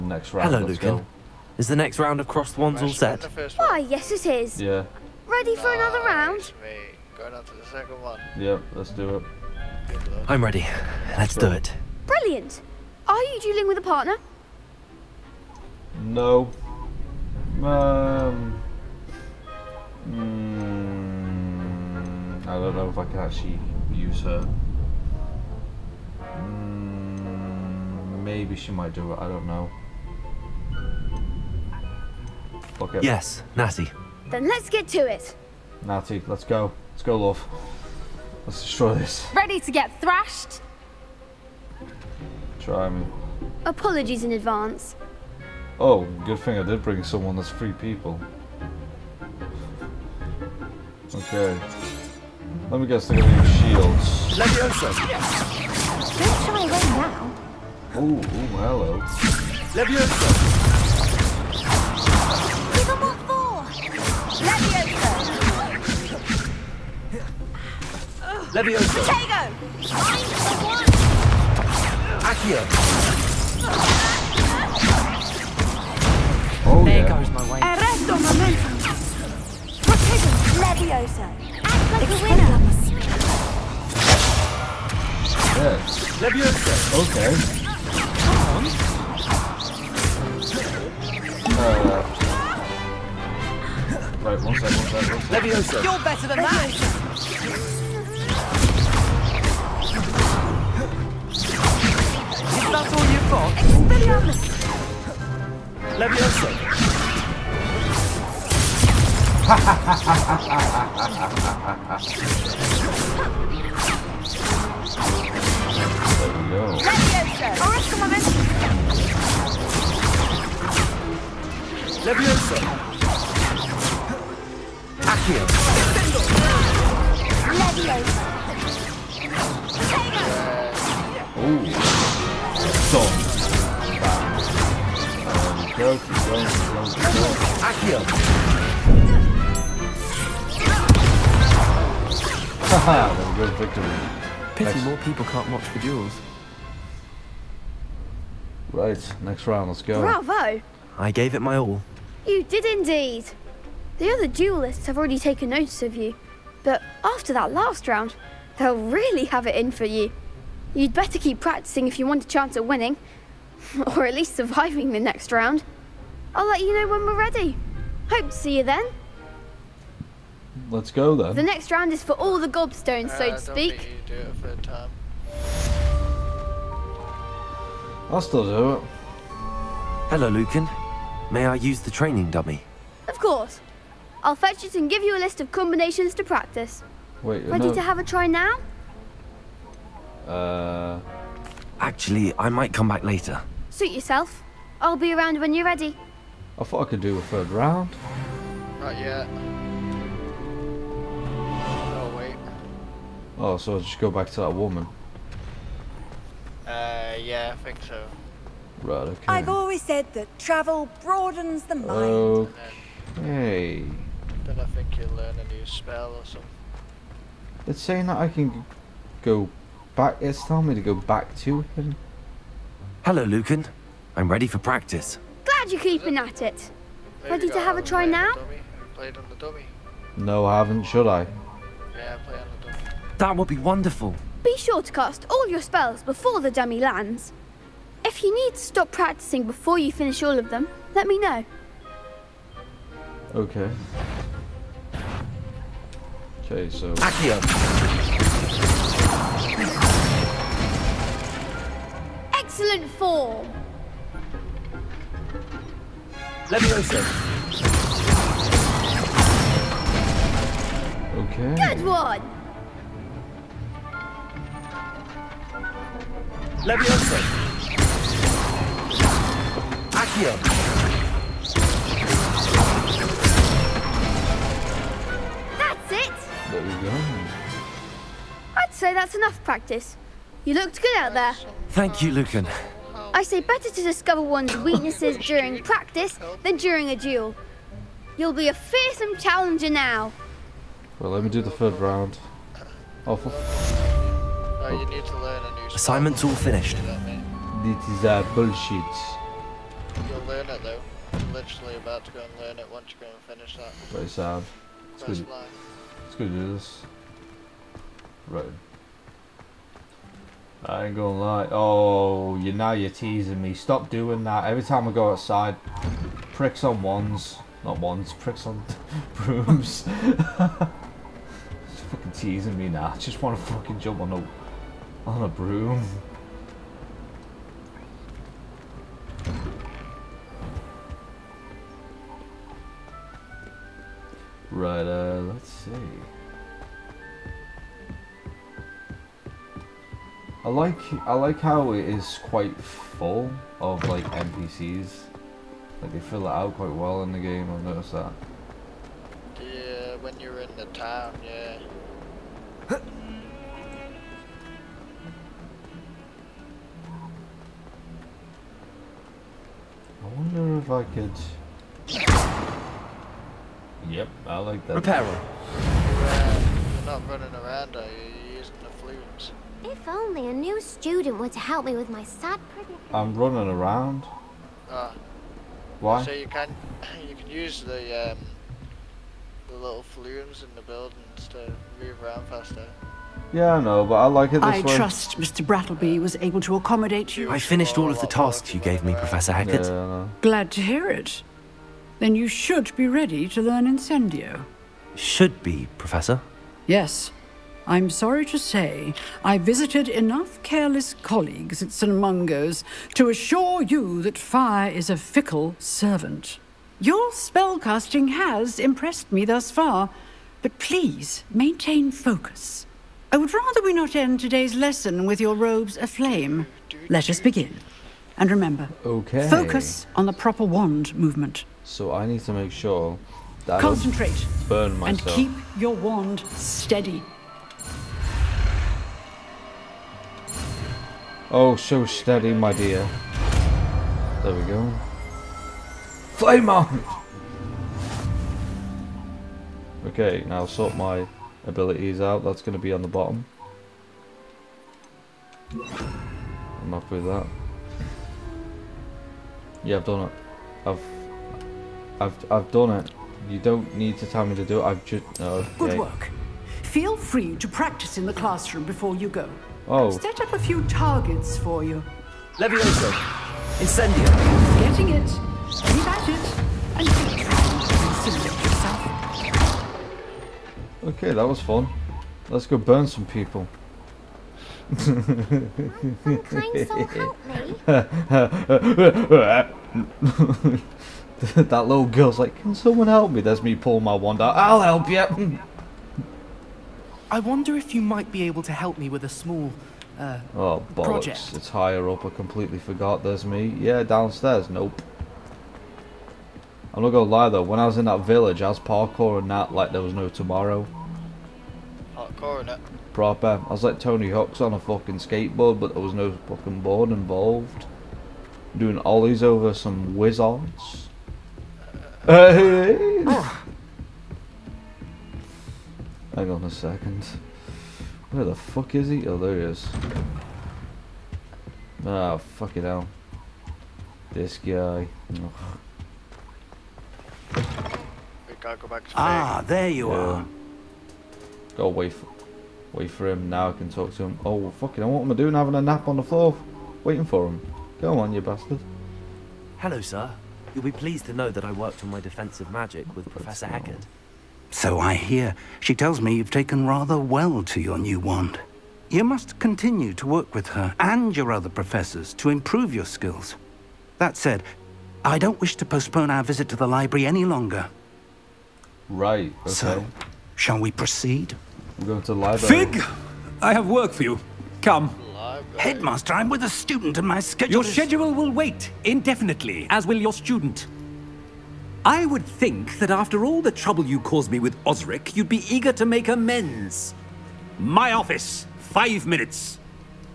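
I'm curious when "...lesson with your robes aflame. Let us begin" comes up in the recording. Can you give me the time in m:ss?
6:54.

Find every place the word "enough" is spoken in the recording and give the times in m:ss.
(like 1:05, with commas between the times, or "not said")
4:39, 6:39.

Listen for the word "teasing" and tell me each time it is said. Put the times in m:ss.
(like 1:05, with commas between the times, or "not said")
5:12, 5:22.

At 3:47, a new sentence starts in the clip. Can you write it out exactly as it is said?
Maybe ready to have a try now?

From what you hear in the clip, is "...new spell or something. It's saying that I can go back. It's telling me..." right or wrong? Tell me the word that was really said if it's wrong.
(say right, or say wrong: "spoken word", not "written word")
right.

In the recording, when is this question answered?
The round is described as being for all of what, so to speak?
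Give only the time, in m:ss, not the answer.
2:52.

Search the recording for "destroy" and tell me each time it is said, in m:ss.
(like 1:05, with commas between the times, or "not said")
0:38.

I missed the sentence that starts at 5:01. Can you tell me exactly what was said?
You're literally about to go and learn it once you go and finish that.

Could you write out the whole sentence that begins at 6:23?
Yeah, I know, but I like it this I way.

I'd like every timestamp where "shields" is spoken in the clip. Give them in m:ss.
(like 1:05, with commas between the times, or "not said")
0:53.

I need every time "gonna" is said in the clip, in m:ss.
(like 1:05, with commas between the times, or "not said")
0:53, 5:10.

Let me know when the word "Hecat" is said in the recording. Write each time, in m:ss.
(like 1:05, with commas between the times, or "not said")
6:29, 9:03.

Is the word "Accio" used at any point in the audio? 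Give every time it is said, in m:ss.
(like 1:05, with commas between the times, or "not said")
1:12, 4:06, 4:30.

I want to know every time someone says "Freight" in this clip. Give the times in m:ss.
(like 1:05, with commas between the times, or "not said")
not said.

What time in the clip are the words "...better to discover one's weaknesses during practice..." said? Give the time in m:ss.
4:43.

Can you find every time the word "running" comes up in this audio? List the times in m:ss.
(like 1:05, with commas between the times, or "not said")
6:07, 6:13.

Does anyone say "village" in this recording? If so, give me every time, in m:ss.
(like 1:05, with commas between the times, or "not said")
8:18.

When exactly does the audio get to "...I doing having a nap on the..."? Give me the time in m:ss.
8:55.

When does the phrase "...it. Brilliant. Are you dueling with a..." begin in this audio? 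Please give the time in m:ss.
0:11.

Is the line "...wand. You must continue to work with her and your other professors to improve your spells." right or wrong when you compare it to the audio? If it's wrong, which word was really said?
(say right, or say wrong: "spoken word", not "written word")
wrong: "skills", not "spells".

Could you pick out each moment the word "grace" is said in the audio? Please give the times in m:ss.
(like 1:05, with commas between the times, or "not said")
not said.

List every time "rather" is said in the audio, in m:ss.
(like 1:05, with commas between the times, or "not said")
6:53, 9:06.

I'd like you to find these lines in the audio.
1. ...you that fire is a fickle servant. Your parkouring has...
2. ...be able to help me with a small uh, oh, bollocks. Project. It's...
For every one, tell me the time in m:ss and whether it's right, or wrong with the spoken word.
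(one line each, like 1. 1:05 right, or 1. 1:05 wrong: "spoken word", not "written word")
1. 6:43 wrong: "spellcasting", not "parkouring"
2. 8:08 right.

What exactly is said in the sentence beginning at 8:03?
There's me pulling my wand out.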